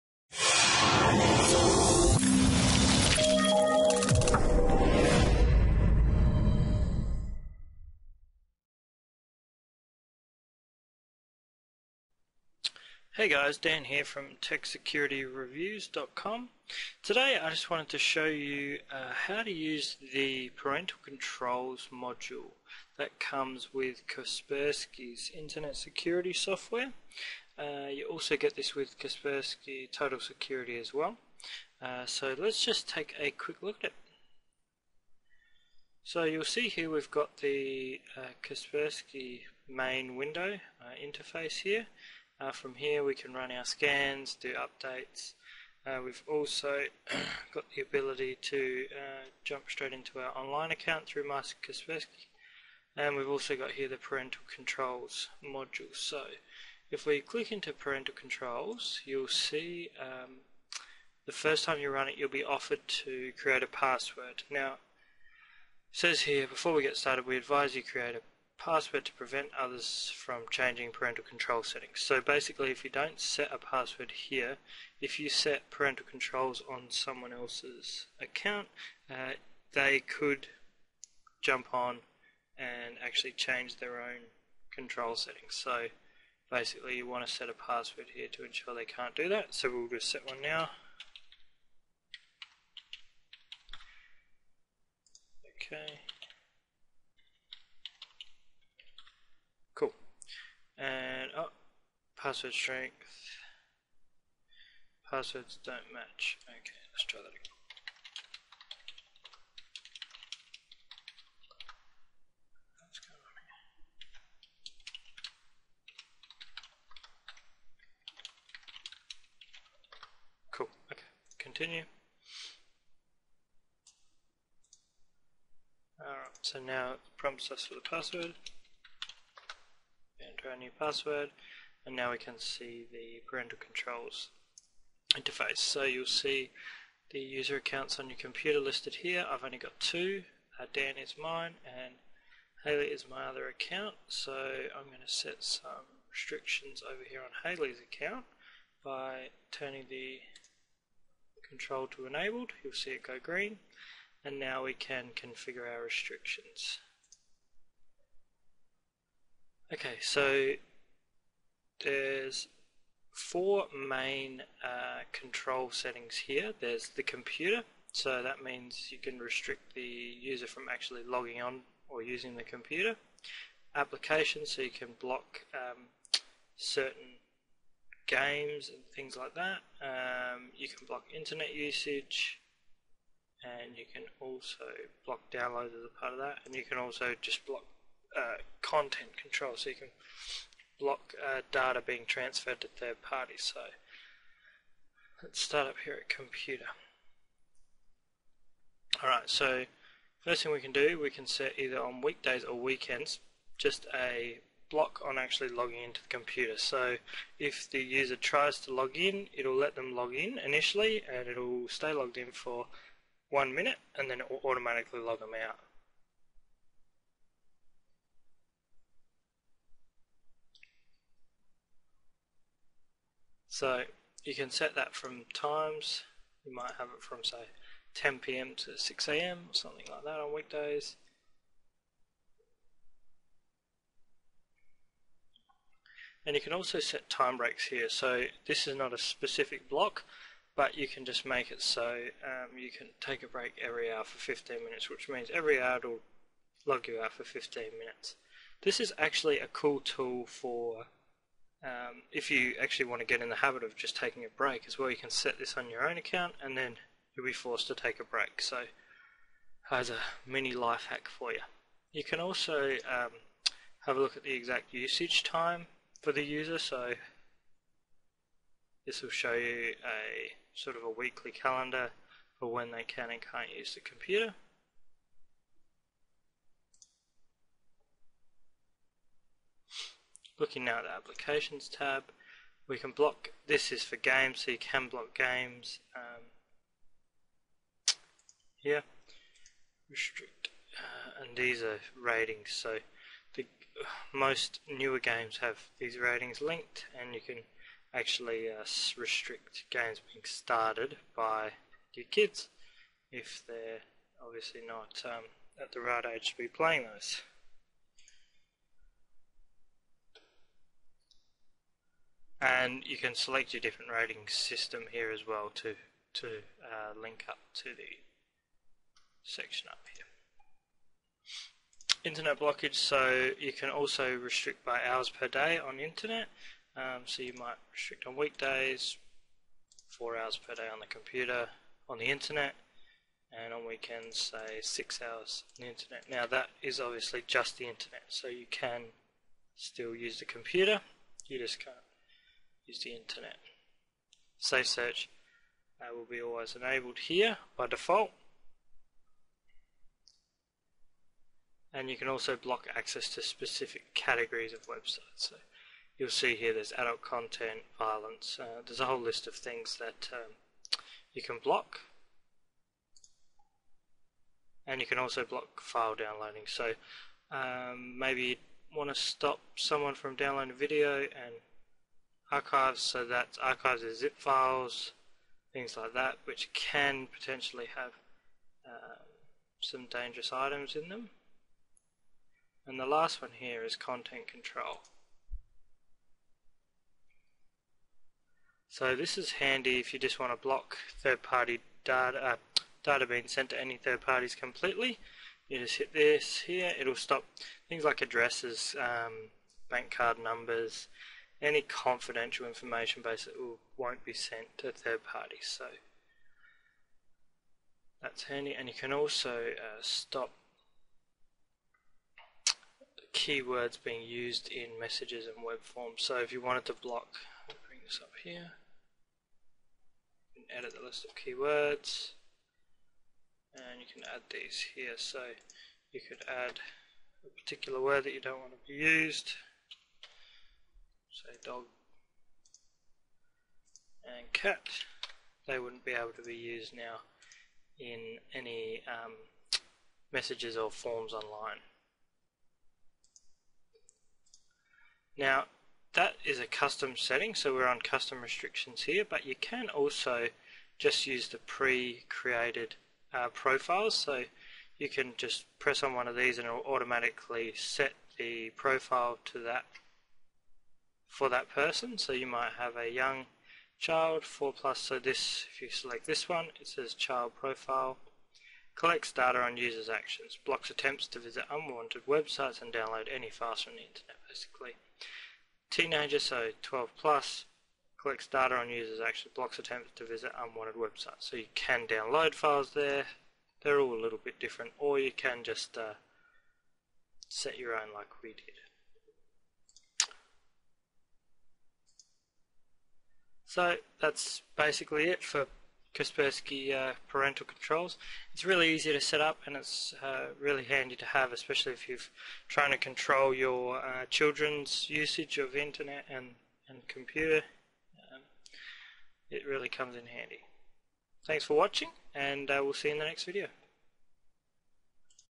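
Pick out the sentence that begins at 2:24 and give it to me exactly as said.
So I'm going to set some restrictions over here on Haley's account by turning the control to enabled.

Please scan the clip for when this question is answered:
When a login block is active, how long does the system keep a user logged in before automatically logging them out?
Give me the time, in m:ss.
3:33.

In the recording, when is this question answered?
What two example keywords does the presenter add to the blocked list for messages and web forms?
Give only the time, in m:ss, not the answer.
7:11.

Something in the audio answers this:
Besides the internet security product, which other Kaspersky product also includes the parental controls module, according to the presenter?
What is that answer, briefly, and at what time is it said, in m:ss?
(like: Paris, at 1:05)
Kaspersky Total Security, at 0:28.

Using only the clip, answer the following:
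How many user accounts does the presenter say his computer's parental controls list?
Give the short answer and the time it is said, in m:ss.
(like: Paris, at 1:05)
2, at 2:19.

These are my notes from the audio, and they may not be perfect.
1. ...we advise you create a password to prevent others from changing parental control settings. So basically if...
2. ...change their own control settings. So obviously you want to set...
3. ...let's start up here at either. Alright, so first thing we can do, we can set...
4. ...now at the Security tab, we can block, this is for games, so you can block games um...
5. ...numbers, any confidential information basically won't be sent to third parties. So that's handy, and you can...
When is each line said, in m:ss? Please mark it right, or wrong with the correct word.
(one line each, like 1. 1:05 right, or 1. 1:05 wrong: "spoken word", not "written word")
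1. 1:07 right
2. 1:23 wrong: "basically", not "obviously"
3. 3:15 wrong: "computer", not "either"
4. 4:40 wrong: "Applications", not "Security"
5. 6:40 right.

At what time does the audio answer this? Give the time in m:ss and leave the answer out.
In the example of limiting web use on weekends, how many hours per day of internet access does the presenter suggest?
5:34.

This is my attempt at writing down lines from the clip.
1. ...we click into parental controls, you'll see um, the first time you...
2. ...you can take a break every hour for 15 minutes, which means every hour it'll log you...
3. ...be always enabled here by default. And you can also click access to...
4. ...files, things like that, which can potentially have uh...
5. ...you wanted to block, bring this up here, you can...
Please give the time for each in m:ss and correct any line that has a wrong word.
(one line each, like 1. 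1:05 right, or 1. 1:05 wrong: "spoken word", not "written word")
1. 0:57 right
2. 4:02 right
3. 5:46 wrong: "block", not "click"
4. 6:14 right
5. 6:56 right.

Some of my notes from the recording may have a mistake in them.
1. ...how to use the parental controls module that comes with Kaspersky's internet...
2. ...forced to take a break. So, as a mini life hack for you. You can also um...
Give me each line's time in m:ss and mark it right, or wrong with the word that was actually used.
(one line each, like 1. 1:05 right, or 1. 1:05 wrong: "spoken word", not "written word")
1. 0:19 right
2. 4:17 right.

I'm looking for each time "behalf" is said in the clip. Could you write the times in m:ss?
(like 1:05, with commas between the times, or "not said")
not said.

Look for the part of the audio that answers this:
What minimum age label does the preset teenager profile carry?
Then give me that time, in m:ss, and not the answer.
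7:56.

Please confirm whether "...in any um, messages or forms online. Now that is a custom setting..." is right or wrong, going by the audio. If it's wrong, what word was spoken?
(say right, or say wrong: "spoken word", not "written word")
right.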